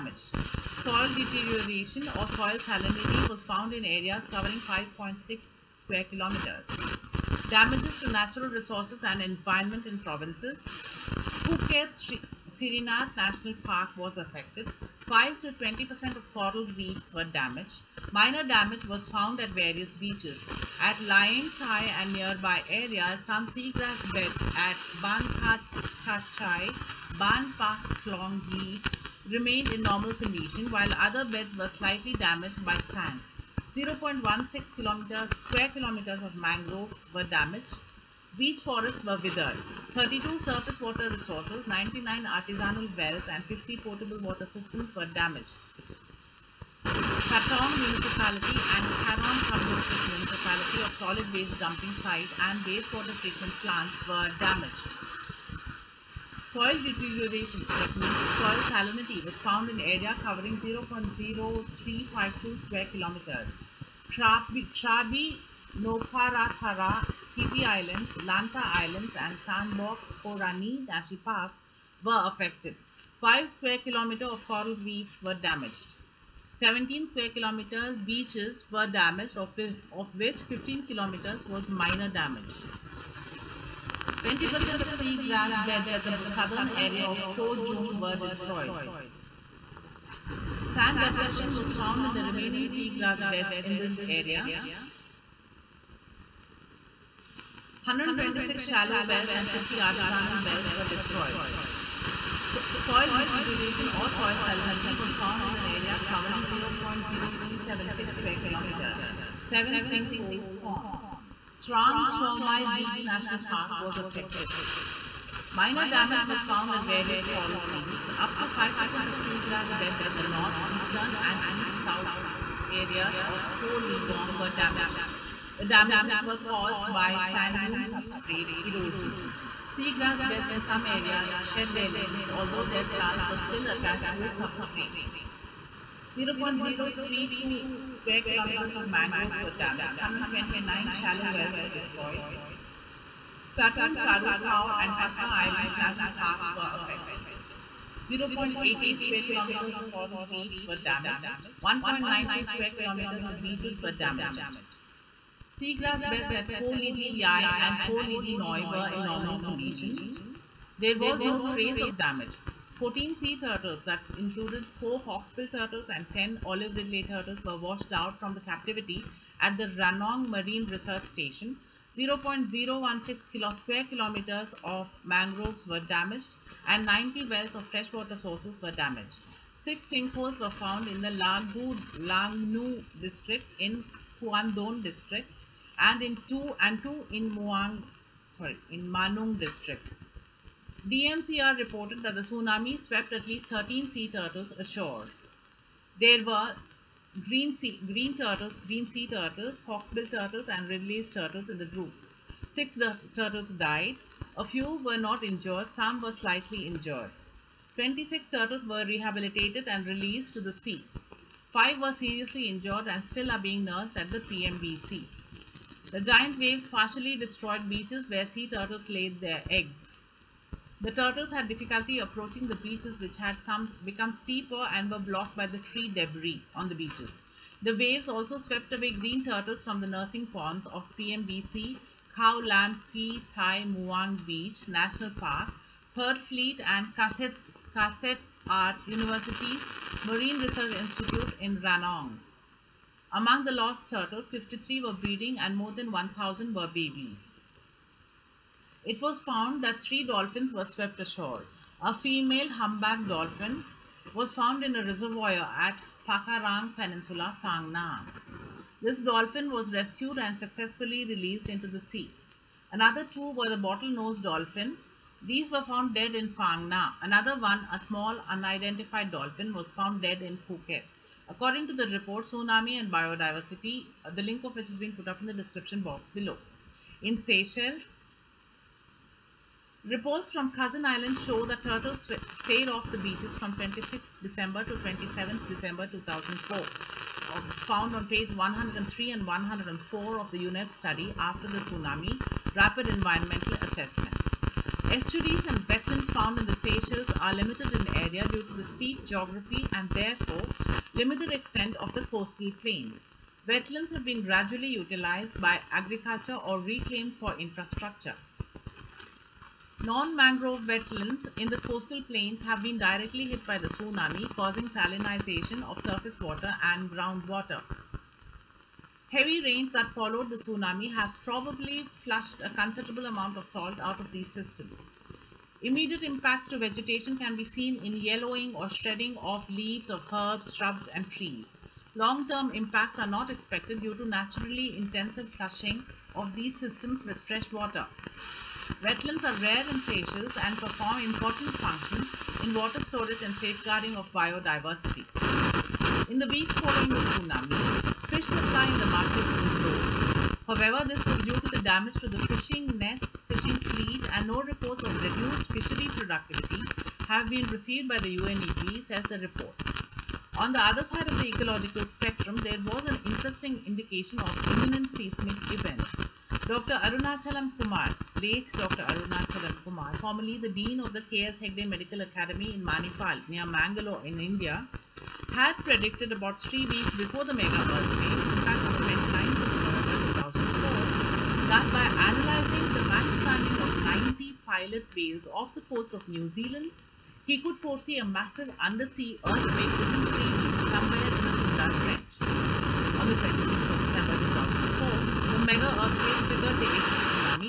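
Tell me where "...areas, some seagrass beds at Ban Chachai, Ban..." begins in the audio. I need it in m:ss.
0:22.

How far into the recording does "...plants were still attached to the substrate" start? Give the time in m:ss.
2:12.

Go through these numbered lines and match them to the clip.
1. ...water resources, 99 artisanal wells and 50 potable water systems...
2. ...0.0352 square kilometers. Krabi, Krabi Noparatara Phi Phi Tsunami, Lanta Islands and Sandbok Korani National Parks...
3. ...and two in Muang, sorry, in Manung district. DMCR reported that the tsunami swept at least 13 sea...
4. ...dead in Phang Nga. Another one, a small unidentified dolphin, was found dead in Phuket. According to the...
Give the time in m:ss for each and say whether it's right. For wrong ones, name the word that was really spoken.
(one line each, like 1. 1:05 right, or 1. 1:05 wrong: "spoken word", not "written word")
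1. 0:40 right
2. 1:00 wrong: "Islands", not "Tsunami"
3. 3:06 right
4. 4:25 right.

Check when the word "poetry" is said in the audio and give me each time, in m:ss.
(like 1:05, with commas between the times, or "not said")
not said.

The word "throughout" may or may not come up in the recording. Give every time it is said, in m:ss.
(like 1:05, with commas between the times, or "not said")
not said.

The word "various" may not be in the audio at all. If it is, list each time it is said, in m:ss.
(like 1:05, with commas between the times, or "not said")
0:19, 1:56.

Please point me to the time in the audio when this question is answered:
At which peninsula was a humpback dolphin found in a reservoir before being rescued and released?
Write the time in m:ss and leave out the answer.
4:16.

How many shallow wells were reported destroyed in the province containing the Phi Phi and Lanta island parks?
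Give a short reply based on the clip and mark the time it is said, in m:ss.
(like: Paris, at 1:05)
126, at 1:37.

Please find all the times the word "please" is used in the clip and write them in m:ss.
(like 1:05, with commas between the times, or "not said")
not said.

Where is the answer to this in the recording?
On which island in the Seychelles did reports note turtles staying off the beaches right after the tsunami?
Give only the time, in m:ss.
4:40.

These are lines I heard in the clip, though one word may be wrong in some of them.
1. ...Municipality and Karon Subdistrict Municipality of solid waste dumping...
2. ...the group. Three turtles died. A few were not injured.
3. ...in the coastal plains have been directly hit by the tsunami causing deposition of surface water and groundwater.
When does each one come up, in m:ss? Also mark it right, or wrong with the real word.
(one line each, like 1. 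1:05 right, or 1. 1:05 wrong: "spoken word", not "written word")
1. 0:47 right
2. 3:21 wrong: "Six", not "Three"
3. 5:11 wrong: "salinization", not "deposition".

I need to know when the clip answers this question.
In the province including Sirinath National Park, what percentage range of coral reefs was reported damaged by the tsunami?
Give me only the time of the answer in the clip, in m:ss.
0:15.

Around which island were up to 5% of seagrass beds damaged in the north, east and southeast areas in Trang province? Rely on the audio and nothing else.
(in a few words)
Koh Libong.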